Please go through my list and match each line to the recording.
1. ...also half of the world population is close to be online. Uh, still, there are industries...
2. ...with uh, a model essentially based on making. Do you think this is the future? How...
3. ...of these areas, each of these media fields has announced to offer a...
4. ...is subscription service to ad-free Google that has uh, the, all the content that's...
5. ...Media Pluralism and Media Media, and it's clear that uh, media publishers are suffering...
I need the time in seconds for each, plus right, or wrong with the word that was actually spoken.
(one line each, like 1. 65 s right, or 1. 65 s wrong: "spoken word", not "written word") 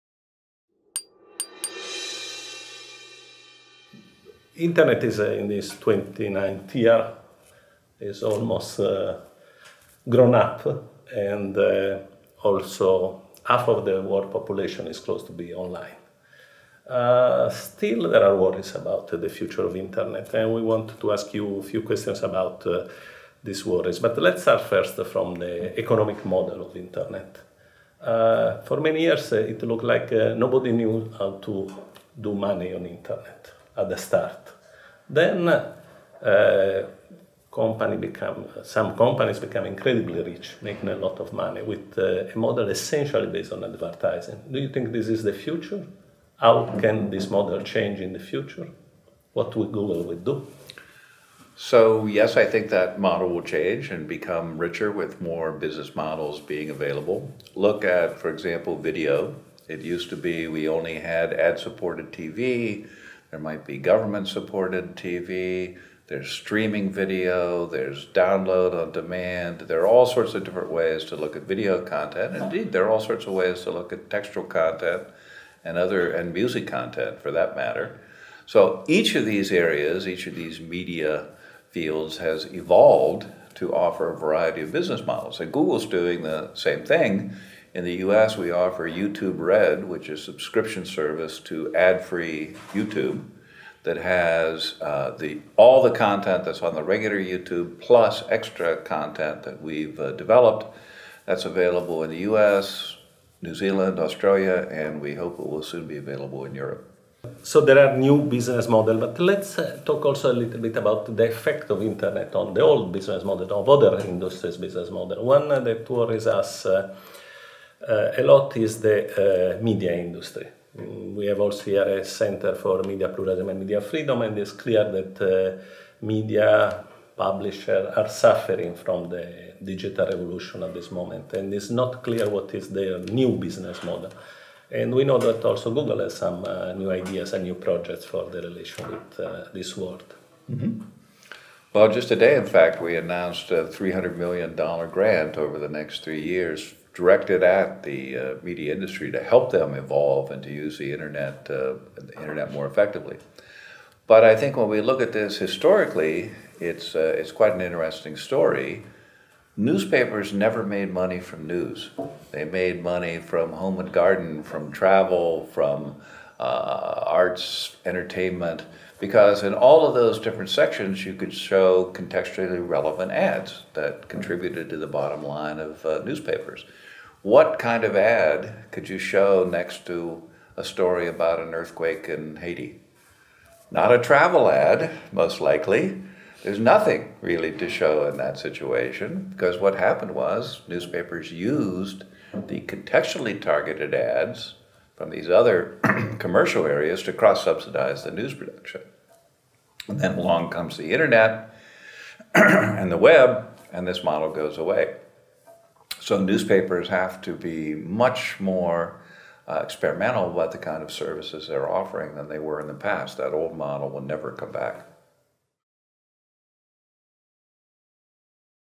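1. 12 s wrong: "worries", not "industries"
2. 41 s wrong: "advertising", not "making"
3. 79 s wrong: "evolved", not "announced"
4. 90 s wrong: "YouTube", not "Google"
5. 122 s wrong: "Freedom", not "Media".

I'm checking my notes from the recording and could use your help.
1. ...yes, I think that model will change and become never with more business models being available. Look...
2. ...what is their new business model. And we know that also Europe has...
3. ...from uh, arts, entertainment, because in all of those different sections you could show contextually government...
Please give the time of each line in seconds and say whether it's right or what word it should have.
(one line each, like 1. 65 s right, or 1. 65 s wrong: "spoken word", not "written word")
1. 52 s wrong: "richer", not "never"
2. 132 s wrong: "Google", not "Europe"
3. 165 s wrong: "relevant", not "government".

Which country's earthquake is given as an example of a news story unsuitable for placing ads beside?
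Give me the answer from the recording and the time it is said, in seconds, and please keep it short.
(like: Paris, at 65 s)
Haiti, at 182 s.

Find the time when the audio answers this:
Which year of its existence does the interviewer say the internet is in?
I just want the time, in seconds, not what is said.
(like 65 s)
5 s.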